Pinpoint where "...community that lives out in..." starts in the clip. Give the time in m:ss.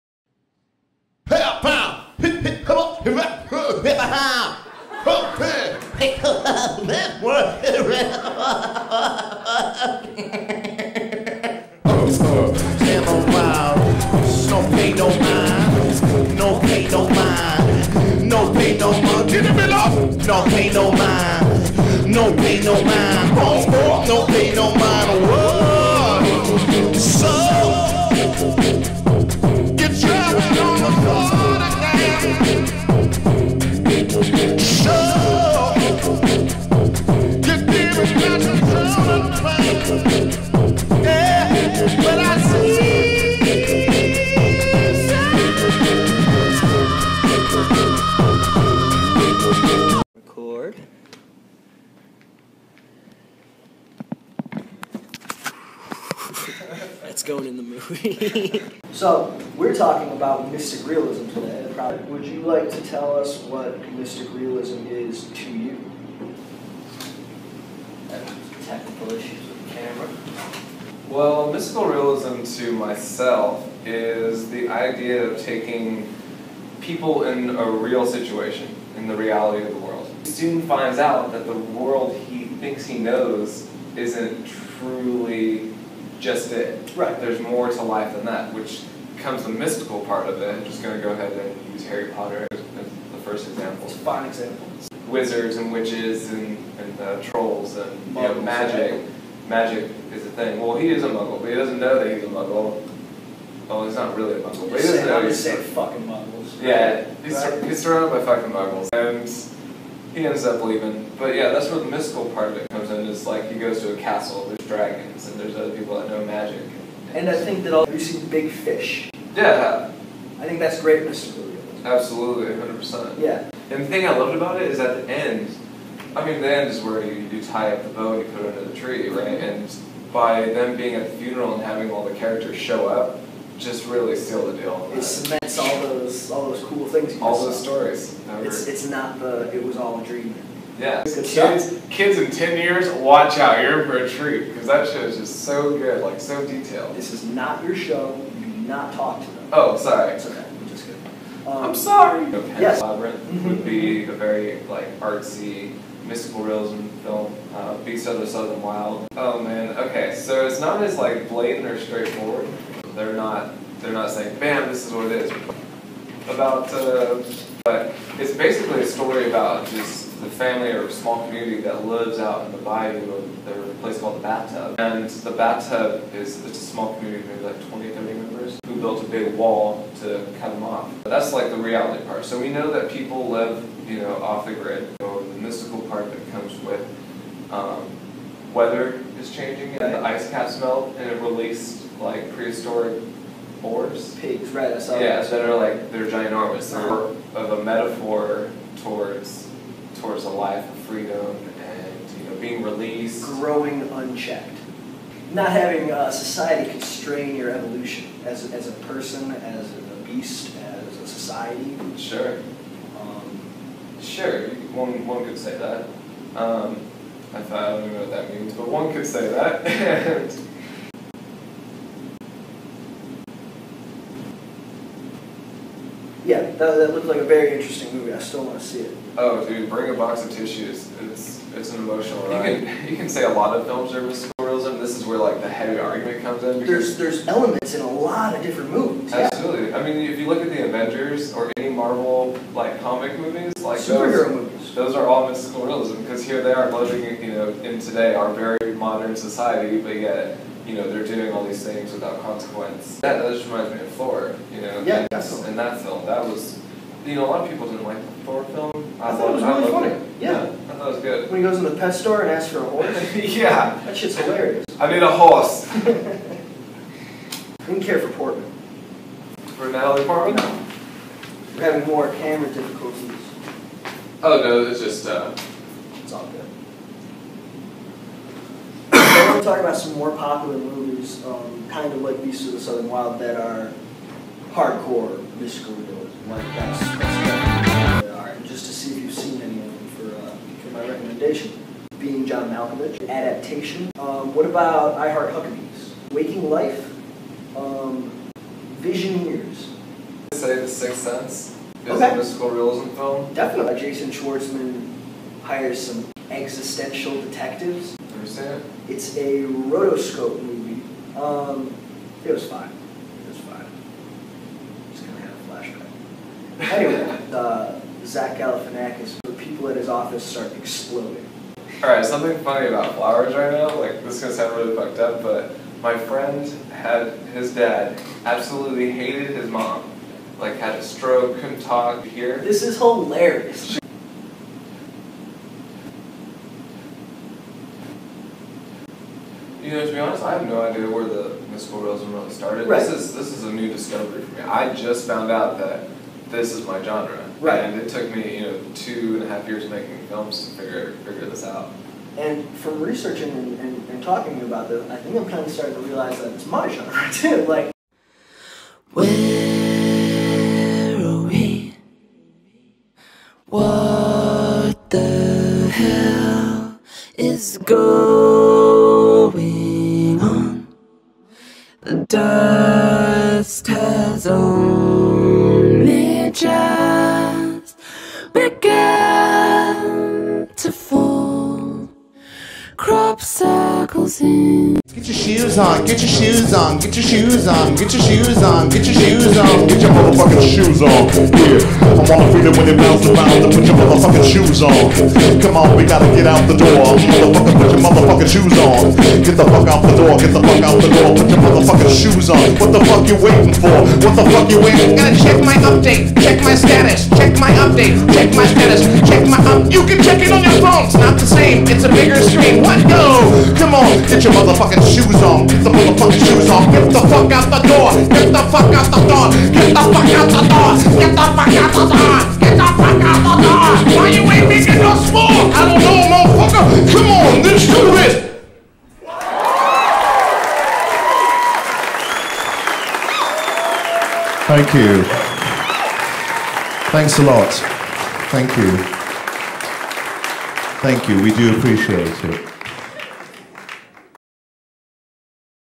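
2:51.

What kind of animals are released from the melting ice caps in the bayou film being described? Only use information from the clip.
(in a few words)
Prehistoric boars.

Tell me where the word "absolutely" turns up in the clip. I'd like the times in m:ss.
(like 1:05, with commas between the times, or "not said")
2:01, 3:59, 5:28.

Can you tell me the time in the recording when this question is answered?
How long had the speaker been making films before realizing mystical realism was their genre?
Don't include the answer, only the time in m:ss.
5:48.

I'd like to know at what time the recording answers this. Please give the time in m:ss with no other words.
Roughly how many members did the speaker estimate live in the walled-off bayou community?
2:57.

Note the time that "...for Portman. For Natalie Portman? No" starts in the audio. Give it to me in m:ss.
4:27.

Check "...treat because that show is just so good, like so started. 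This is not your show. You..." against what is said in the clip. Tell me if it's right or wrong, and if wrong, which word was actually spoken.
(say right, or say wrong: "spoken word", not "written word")
wrong: "detailed", not "started".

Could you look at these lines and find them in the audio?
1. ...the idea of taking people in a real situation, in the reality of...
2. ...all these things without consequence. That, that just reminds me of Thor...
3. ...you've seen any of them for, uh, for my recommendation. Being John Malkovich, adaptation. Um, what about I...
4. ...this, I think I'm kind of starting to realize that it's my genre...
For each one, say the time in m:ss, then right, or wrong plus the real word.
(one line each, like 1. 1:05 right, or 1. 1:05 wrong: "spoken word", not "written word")
1. 1:14 right
2. 4:11 right
3. 4:49 right
4. 5:54 right.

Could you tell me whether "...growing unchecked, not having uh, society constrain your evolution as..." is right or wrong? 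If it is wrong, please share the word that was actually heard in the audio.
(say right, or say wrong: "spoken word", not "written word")
right.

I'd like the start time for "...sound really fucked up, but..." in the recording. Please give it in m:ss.
5:24.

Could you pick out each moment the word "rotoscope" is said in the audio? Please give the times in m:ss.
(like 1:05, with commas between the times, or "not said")
5:09.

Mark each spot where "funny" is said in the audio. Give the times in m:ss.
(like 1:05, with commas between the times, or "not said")
4:19, 5:22.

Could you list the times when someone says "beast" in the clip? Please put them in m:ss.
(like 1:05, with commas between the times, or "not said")
2:37, 3:30, 4:42.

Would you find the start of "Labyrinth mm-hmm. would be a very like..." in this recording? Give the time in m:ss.
2:32.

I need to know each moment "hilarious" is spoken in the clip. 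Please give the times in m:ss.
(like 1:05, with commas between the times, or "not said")
4:24, 5:32.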